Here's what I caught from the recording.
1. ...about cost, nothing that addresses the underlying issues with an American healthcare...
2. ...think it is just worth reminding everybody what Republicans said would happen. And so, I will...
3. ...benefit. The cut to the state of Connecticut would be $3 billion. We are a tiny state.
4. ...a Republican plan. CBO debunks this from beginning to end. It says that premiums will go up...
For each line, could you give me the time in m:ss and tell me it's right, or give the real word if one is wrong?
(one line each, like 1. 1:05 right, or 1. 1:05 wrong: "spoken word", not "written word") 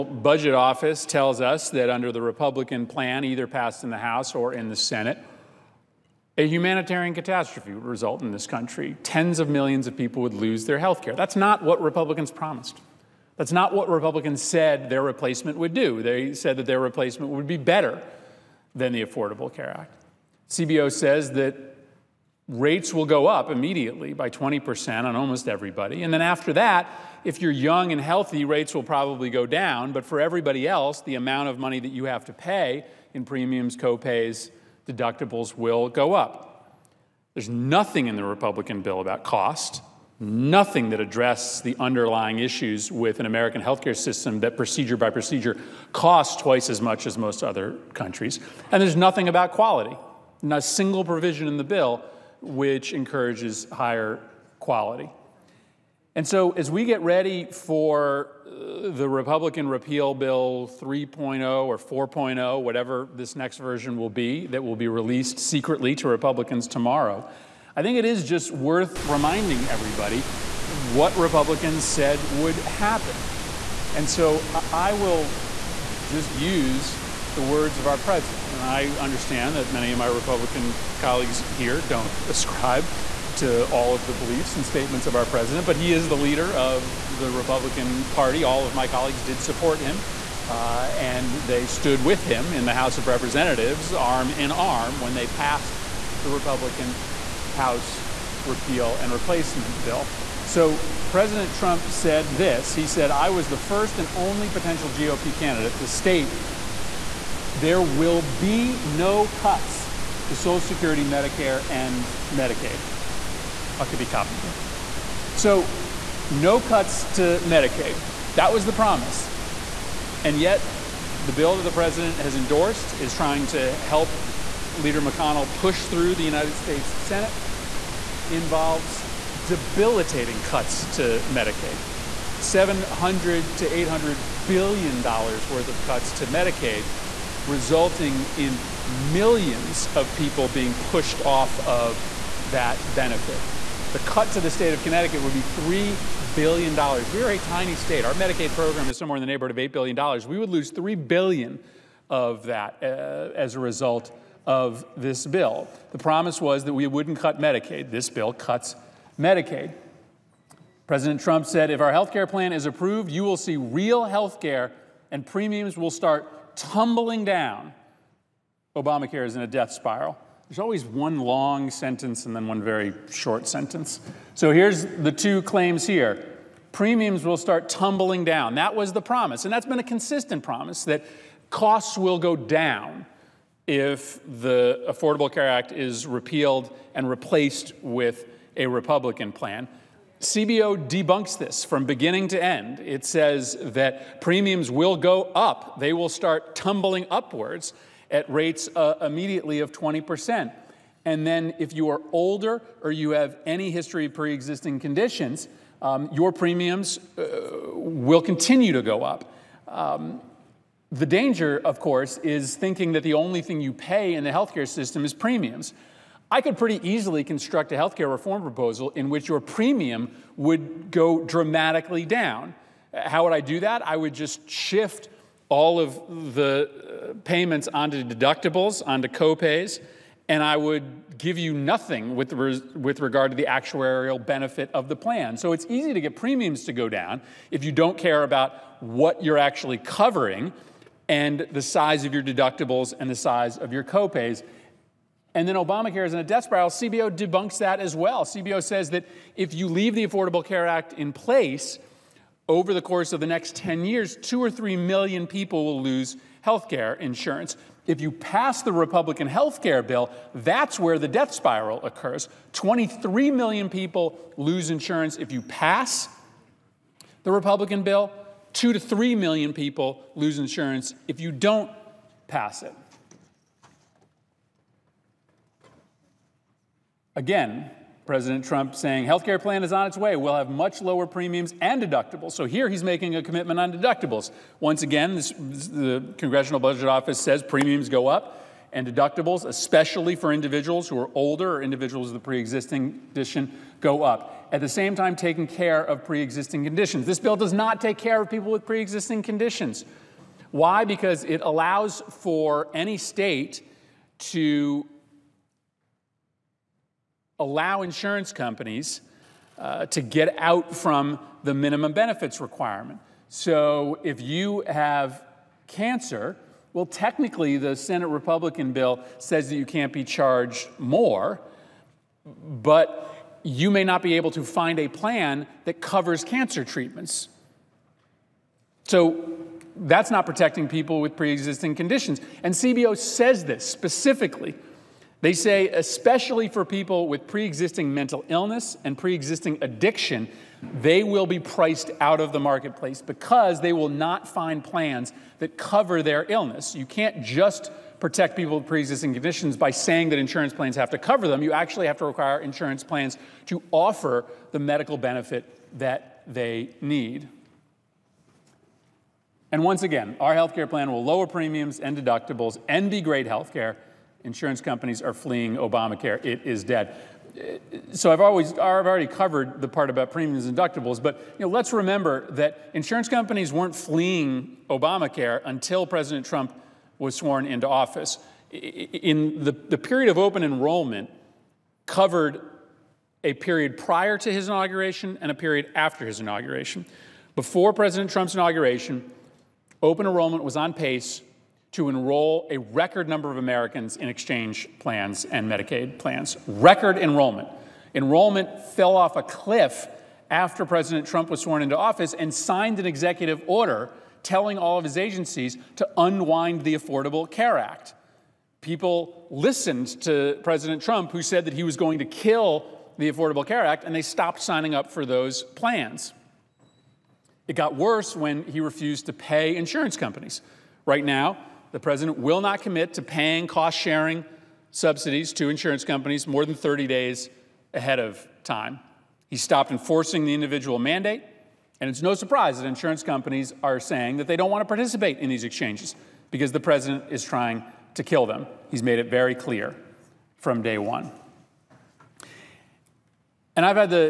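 1. 0:39 right
2. 1:07 right
3. 2:22 right
4. 3:08 right.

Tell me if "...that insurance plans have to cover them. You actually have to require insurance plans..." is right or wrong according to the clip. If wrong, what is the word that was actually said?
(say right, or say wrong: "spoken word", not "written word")
right.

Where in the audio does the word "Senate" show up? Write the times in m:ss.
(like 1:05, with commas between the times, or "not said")
0:04, 2:06, 5:17.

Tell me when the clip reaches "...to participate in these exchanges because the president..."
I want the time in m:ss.
7:14.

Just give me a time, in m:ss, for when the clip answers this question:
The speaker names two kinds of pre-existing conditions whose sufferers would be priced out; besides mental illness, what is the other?
5:39.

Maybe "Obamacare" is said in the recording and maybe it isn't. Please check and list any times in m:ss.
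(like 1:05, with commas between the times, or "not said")
2:48, 4:05, 6:05, 6:14.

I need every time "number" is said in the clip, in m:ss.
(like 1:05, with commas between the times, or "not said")
6:33.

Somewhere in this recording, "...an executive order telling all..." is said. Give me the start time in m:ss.
6:42.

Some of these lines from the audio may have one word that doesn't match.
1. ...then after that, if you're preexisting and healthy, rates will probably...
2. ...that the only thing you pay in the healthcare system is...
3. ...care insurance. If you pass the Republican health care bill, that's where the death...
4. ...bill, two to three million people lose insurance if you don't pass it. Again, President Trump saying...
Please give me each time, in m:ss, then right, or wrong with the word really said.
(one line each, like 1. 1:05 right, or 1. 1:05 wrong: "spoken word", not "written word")
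1. 0:26 wrong: "young", not "preexisting"
2. 3:32 right
3. 4:16 right
4. 4:27 right.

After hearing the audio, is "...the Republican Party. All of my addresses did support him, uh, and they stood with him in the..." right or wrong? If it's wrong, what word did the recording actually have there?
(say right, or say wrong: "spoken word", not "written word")
wrong: "colleagues", not "addresses".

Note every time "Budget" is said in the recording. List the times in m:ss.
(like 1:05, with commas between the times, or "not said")
0:00, 4:46.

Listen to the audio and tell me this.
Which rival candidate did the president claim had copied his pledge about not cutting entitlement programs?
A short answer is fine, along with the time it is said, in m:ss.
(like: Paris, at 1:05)
Huckabee, at 1:53.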